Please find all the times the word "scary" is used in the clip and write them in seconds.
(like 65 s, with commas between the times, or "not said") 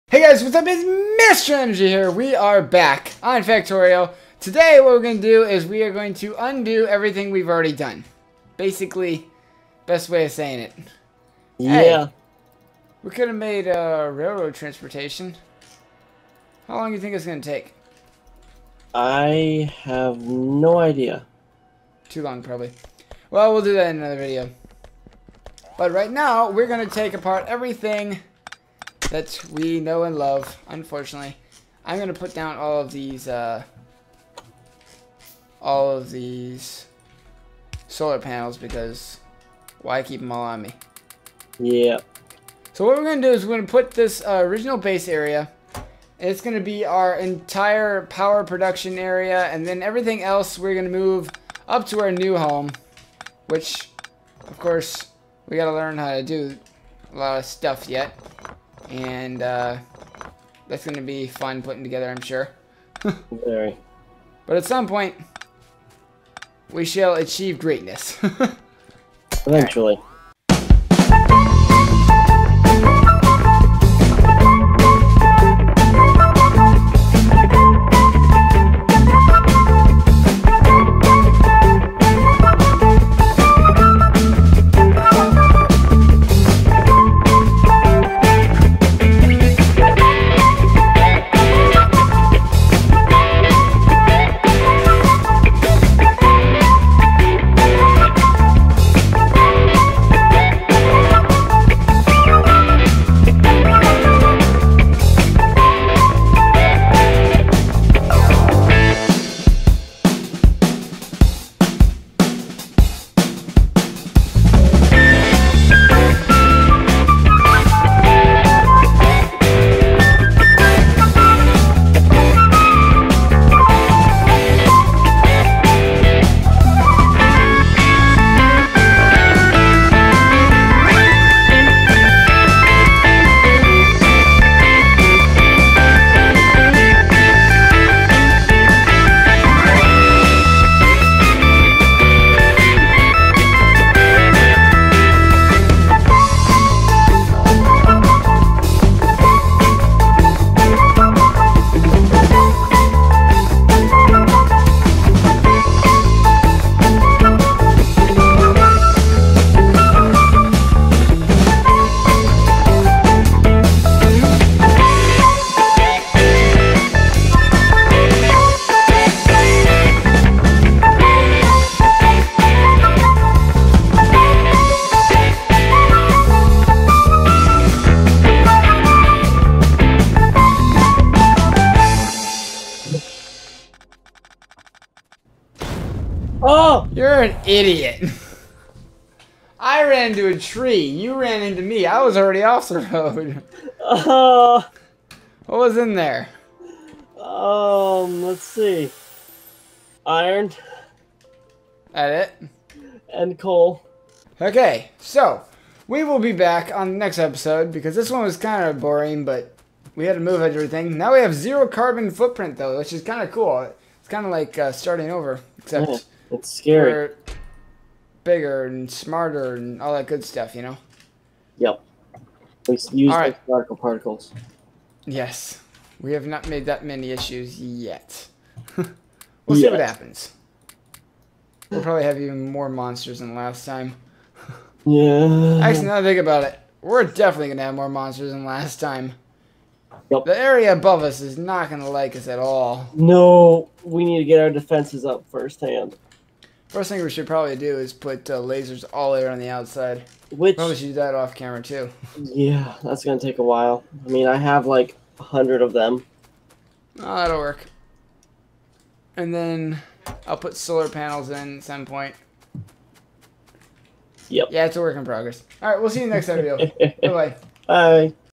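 216 s.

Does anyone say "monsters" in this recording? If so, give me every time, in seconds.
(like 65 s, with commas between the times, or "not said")
232 s, 237 s.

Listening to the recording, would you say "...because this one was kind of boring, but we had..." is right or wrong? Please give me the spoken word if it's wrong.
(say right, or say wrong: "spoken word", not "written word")
right.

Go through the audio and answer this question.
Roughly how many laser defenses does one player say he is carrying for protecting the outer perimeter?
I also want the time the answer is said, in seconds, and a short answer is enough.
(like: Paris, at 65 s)
100, at 255 s.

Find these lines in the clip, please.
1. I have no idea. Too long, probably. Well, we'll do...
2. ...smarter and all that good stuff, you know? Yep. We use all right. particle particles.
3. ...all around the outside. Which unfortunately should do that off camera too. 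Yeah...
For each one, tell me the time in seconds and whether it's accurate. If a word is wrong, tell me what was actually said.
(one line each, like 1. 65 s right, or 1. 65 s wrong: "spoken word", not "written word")
1. 18 s right
2. 218 s right
3. 248 s wrong: "probably", not "unfortunately".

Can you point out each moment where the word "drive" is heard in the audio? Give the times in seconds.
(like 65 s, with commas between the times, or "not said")
not said.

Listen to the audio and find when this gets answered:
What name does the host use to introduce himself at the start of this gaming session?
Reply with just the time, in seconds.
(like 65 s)
0 s.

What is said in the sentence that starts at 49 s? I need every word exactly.
And then everything else we're going to move up to our new home.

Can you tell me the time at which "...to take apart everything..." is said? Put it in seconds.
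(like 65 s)
26 s.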